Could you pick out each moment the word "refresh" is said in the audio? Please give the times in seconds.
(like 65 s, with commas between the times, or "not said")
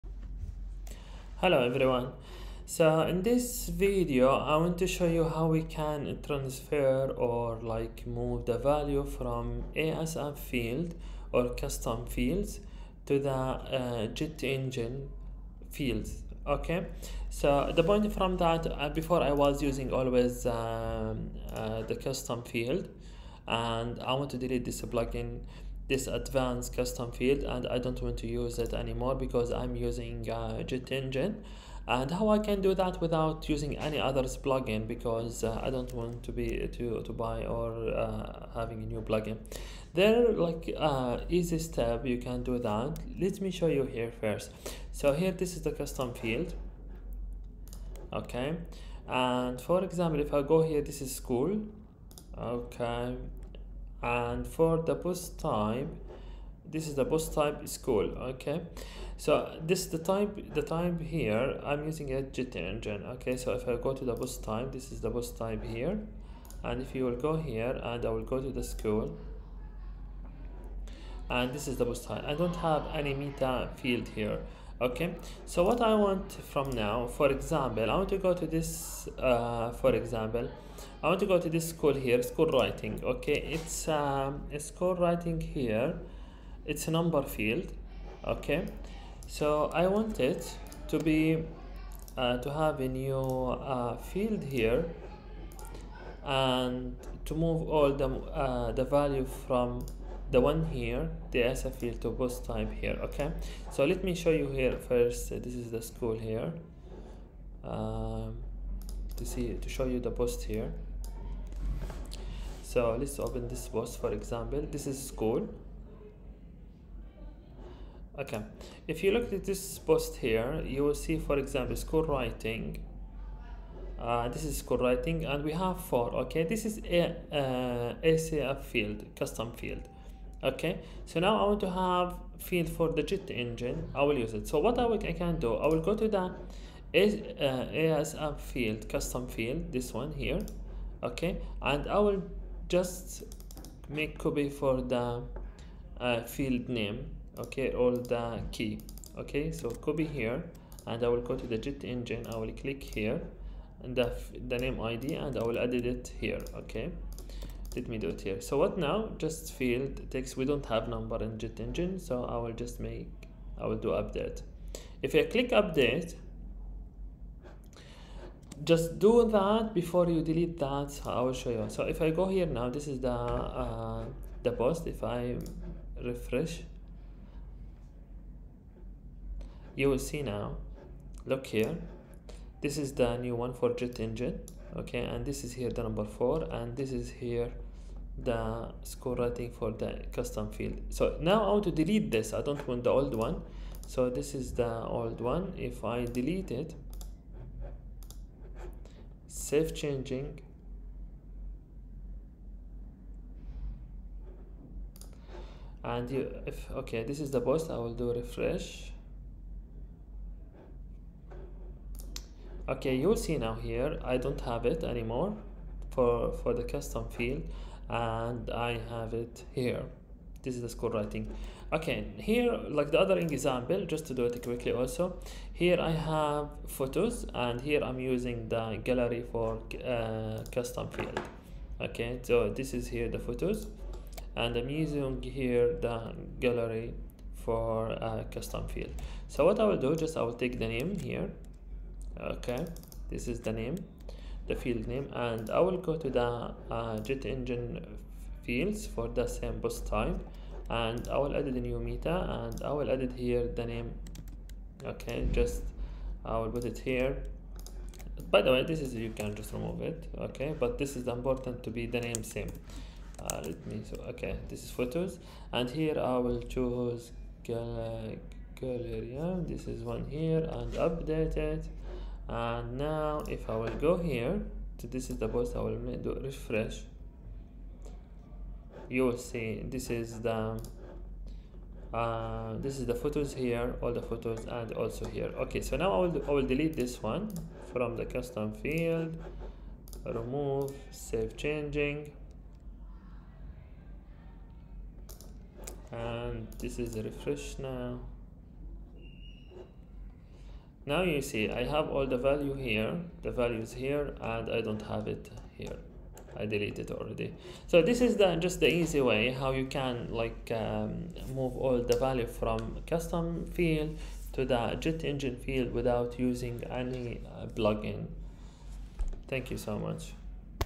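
176 s, 208 s, 276 s, 296 s.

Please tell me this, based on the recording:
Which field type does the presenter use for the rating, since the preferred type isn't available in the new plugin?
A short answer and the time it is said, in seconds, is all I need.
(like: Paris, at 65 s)
Text, at 160 s.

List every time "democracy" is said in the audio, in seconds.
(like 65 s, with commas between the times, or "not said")
not said.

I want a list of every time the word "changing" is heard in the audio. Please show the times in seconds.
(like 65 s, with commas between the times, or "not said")
199 s, 291 s.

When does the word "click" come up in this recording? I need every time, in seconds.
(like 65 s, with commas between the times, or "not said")
152 s, 165 s.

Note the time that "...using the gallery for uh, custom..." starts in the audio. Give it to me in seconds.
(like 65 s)
227 s.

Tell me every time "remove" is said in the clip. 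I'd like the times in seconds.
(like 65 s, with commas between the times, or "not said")
259 s, 290 s.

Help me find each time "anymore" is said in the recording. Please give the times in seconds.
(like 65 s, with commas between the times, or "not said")
28 s, 214 s.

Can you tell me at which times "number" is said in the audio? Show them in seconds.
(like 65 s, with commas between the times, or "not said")
86 s, 160 s, 185 s.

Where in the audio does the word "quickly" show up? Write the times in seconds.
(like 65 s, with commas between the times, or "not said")
224 s.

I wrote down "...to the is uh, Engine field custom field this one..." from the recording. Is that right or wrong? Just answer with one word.
wrong.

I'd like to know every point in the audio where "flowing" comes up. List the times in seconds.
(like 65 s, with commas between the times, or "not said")
not said.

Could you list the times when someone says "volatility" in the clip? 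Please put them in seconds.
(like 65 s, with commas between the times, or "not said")
not said.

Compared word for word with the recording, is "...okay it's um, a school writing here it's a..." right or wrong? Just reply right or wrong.
right.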